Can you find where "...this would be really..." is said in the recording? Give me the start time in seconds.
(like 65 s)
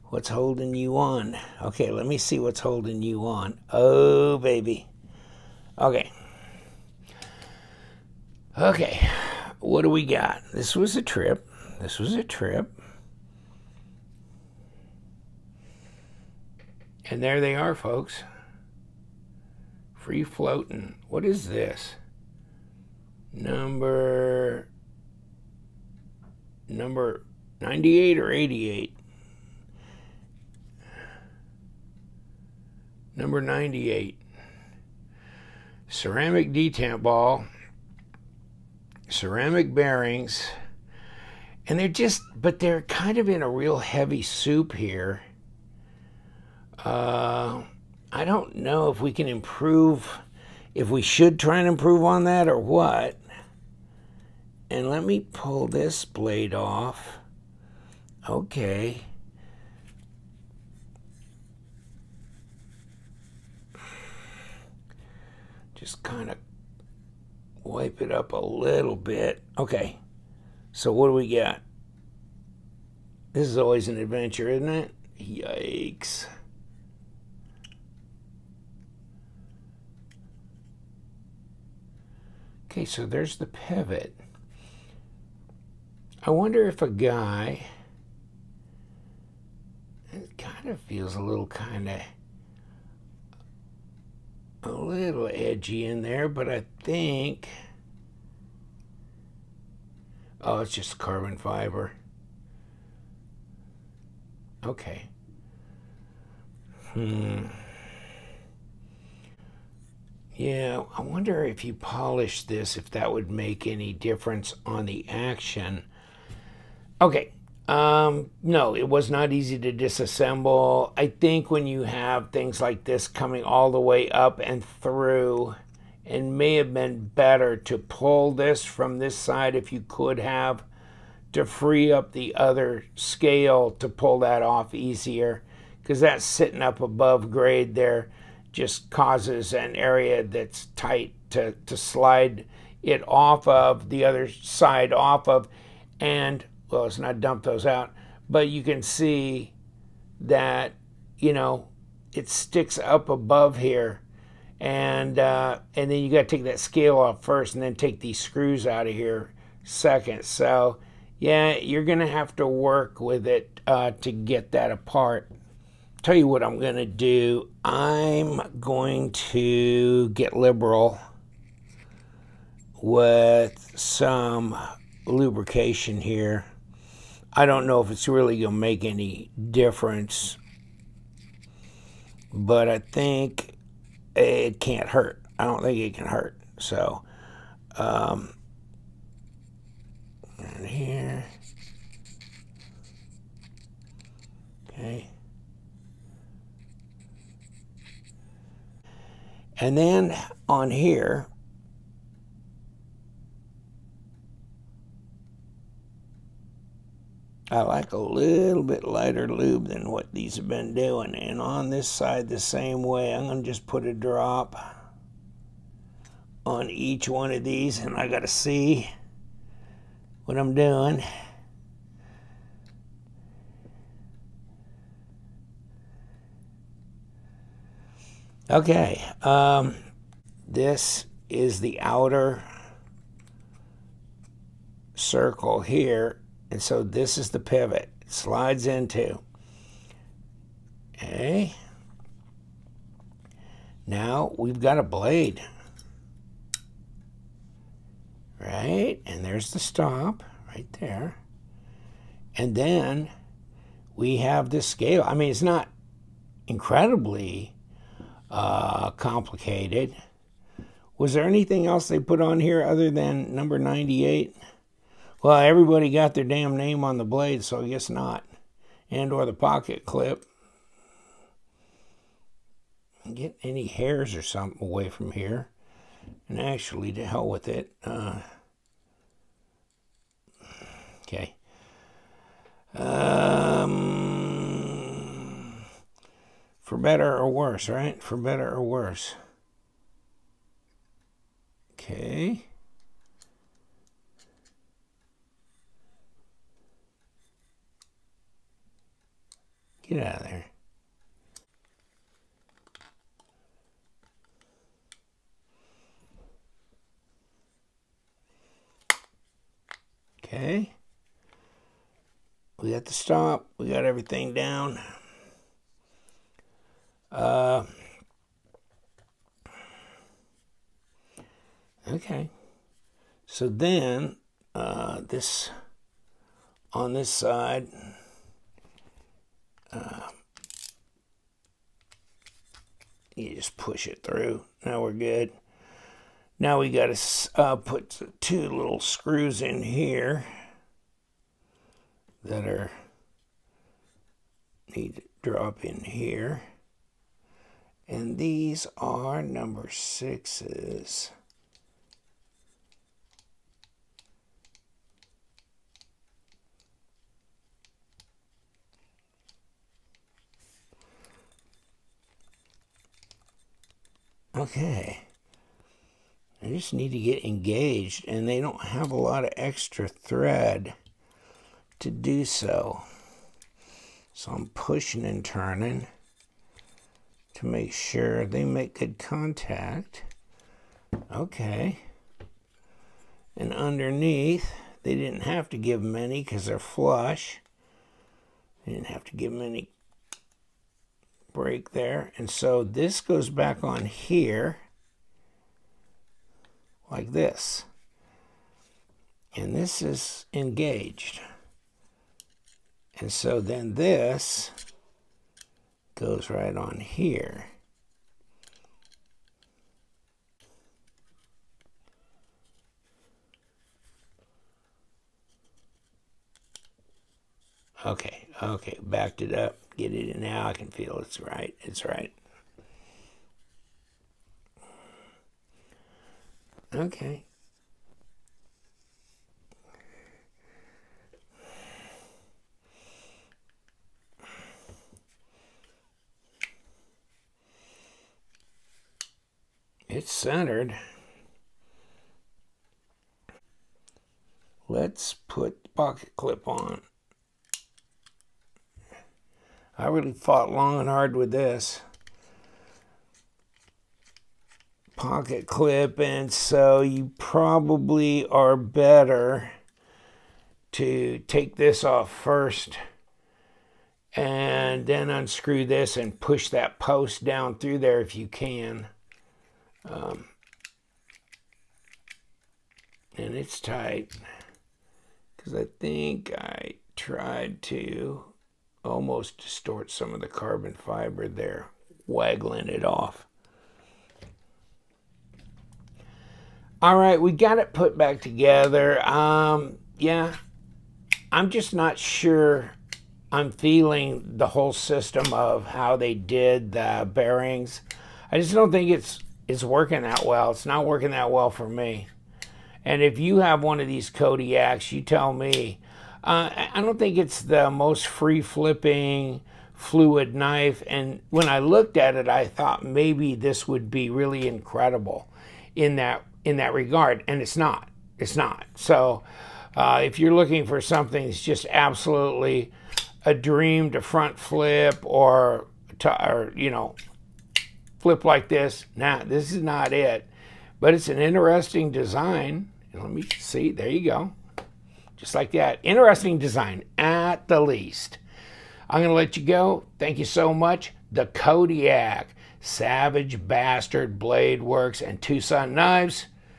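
513 s.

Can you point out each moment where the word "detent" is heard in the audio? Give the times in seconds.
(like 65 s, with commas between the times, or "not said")
36 s.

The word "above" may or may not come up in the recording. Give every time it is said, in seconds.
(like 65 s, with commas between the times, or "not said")
136 s, 153 s.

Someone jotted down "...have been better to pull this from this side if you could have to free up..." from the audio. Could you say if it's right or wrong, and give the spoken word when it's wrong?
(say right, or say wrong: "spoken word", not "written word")
right.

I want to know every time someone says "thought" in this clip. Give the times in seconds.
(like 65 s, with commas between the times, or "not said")
512 s.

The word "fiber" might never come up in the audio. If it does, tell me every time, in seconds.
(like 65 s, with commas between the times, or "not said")
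101 s, 480 s.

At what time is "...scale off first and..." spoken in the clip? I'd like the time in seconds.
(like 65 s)
156 s.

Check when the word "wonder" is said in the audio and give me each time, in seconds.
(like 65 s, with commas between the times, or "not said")
86 s, 111 s.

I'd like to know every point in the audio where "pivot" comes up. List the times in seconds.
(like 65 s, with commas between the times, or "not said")
83 s, 237 s.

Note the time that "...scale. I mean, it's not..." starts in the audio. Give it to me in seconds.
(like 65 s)
254 s.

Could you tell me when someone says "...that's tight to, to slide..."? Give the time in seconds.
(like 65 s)
140 s.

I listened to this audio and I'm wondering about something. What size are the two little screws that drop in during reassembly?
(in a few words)
Number sixes.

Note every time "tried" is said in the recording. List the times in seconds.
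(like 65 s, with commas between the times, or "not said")
476 s.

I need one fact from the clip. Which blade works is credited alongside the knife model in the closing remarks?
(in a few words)
Savage Bastard Blade Works.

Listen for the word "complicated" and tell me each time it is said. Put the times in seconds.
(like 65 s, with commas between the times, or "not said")
258 s.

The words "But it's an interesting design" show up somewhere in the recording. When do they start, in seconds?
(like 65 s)
530 s.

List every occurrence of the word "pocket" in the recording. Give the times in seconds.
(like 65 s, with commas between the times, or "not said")
269 s, 445 s, 454 s.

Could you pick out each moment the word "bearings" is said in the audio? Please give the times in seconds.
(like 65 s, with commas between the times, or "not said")
39 s, 497 s.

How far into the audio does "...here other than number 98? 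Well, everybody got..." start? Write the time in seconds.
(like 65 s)
262 s.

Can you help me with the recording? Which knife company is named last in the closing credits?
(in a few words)
TwoSun Knives.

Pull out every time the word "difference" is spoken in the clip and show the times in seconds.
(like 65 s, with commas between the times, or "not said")
113 s, 179 s.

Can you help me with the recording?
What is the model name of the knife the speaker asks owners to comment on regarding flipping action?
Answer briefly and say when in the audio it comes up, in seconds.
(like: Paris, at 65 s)
Kodiak, at 504 s.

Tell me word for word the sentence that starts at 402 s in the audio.
And so then this goes right on here.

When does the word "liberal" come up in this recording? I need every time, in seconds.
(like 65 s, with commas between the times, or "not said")
170 s.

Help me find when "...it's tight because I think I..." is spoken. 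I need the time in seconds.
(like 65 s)
473 s.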